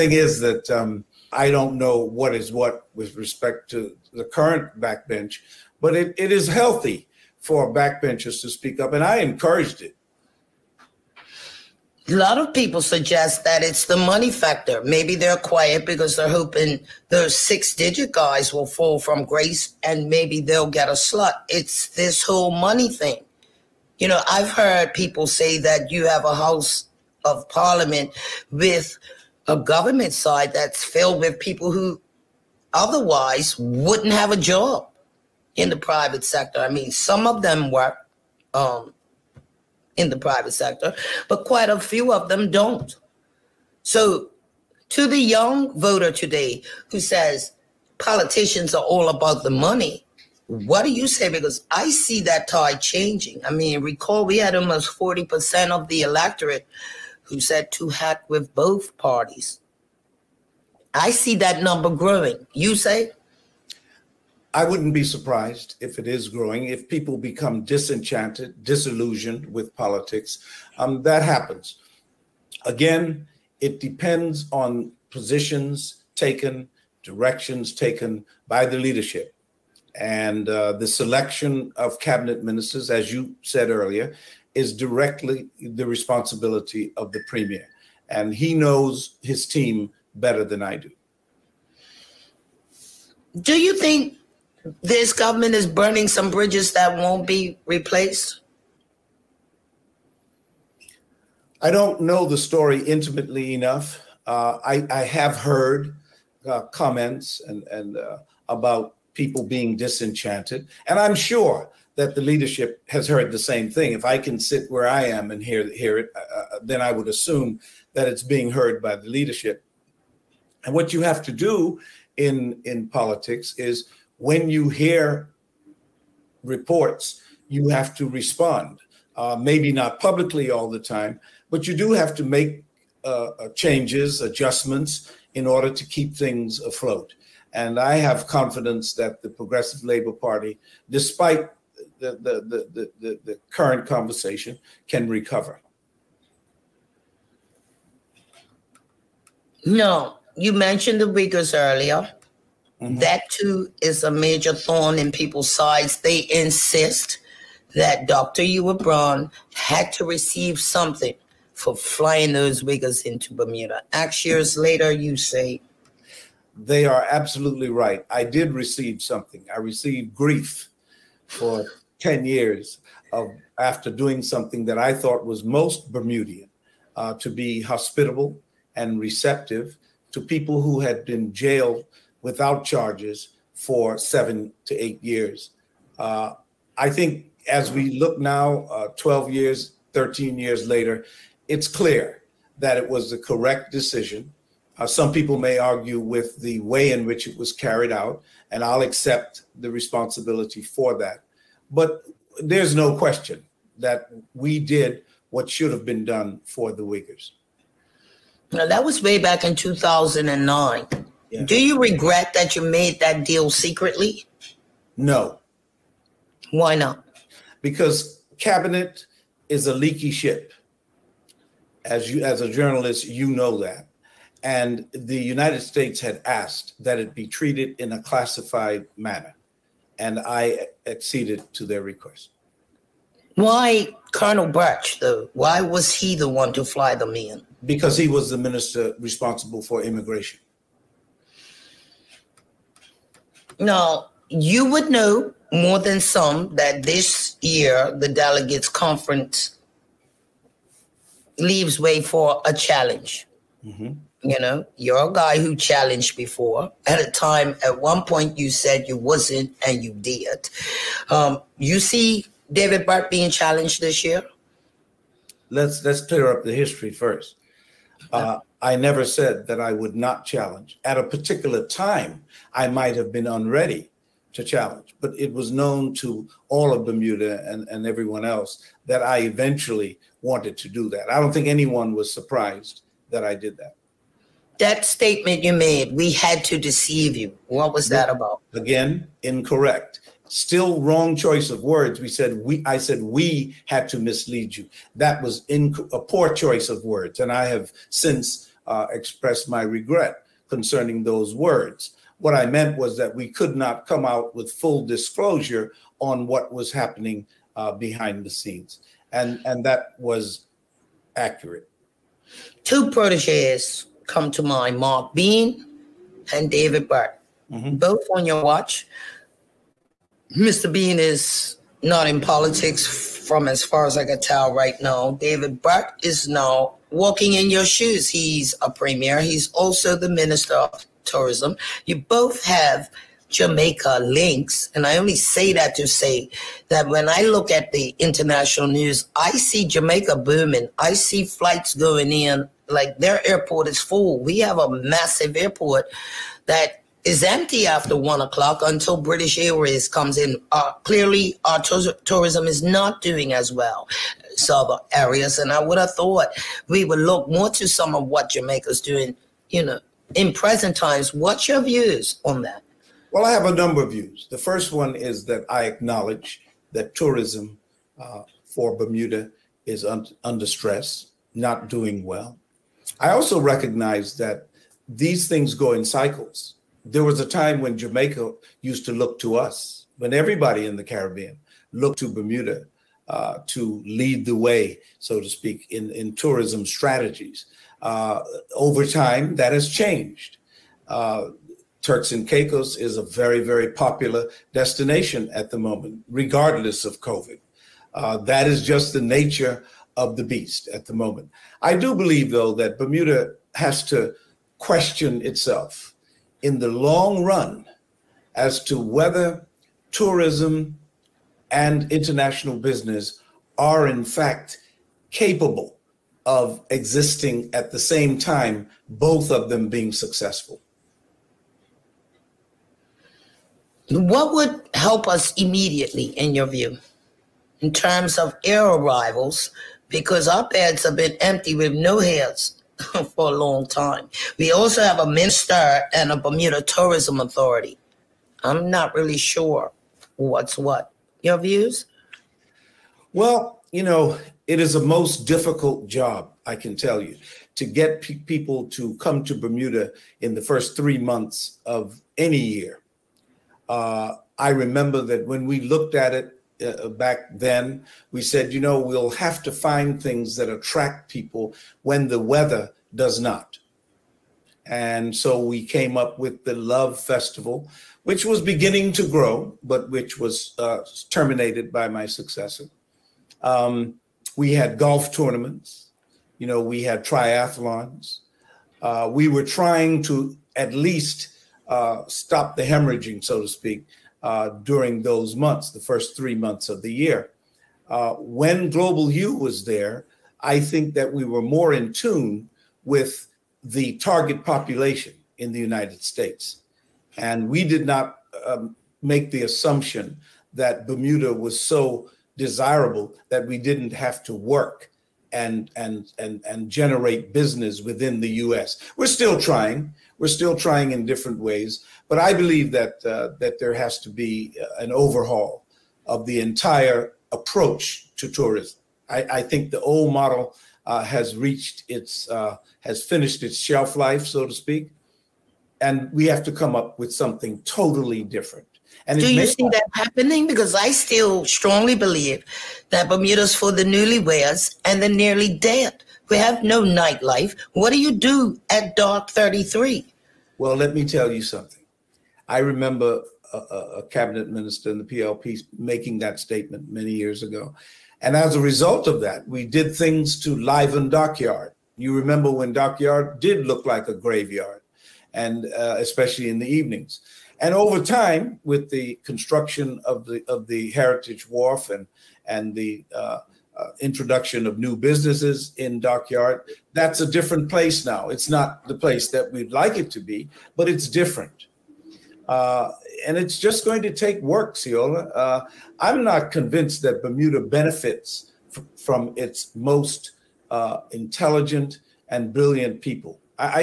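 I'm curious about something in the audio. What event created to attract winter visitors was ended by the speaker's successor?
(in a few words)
Love Festival.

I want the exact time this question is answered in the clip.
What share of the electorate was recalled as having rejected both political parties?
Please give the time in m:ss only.
0:54.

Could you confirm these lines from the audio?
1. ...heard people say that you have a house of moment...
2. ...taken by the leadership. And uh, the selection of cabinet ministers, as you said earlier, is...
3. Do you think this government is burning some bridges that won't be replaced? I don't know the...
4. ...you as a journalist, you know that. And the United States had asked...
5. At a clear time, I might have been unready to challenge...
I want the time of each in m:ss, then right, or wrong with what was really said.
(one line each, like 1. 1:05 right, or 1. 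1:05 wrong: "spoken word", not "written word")
1. 0:24 wrong: "parliament", not "moment"
2. 1:17 right
3. 1:33 right
4. 3:42 right
5. 4:30 wrong: "particular", not "clear".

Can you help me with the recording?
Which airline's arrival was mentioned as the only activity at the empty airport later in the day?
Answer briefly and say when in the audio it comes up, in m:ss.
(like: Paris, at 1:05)
British Airways, at 5:49.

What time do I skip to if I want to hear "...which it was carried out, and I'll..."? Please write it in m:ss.
3:17.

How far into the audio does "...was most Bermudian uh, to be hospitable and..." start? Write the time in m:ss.
2:55.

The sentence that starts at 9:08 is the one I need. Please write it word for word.
And as a result of that, we did things to liven Dockyard.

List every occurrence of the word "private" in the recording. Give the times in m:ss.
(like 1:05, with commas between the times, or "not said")
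0:35, 0:40.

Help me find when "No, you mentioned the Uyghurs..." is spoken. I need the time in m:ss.
2:29.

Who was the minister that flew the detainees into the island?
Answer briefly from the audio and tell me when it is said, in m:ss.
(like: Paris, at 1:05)
Colonel Burch, at 3:54.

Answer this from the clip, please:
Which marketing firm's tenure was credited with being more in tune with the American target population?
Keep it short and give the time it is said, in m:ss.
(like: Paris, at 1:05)
GlobalHue, at 8:08.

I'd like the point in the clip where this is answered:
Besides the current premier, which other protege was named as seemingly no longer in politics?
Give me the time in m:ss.
5:14.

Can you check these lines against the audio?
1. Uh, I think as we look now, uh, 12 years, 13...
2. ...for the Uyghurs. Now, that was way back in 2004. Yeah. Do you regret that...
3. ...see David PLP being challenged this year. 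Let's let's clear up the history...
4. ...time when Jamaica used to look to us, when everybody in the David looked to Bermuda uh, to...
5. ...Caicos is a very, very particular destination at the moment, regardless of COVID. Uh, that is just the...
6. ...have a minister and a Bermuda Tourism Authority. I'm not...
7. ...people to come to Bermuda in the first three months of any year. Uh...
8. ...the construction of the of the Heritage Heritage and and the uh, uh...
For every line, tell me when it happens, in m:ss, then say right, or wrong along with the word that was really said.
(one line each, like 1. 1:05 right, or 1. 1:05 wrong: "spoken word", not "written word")
1. 3:05 right
2. 3:26 wrong: "2009", not "2004"
3. 4:21 wrong: "Burt", not "PLP"
4. 6:17 wrong: "Caribbean", not "David"
5. 6:32 wrong: "popular", not "particular"
6. 7:14 right
7. 7:28 right
8. 9:18 wrong: "Wharf", not "Heritage".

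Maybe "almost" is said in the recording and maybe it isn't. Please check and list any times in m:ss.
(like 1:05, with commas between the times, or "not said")
0:54.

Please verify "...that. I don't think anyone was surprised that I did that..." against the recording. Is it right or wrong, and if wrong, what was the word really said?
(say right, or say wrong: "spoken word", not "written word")
right.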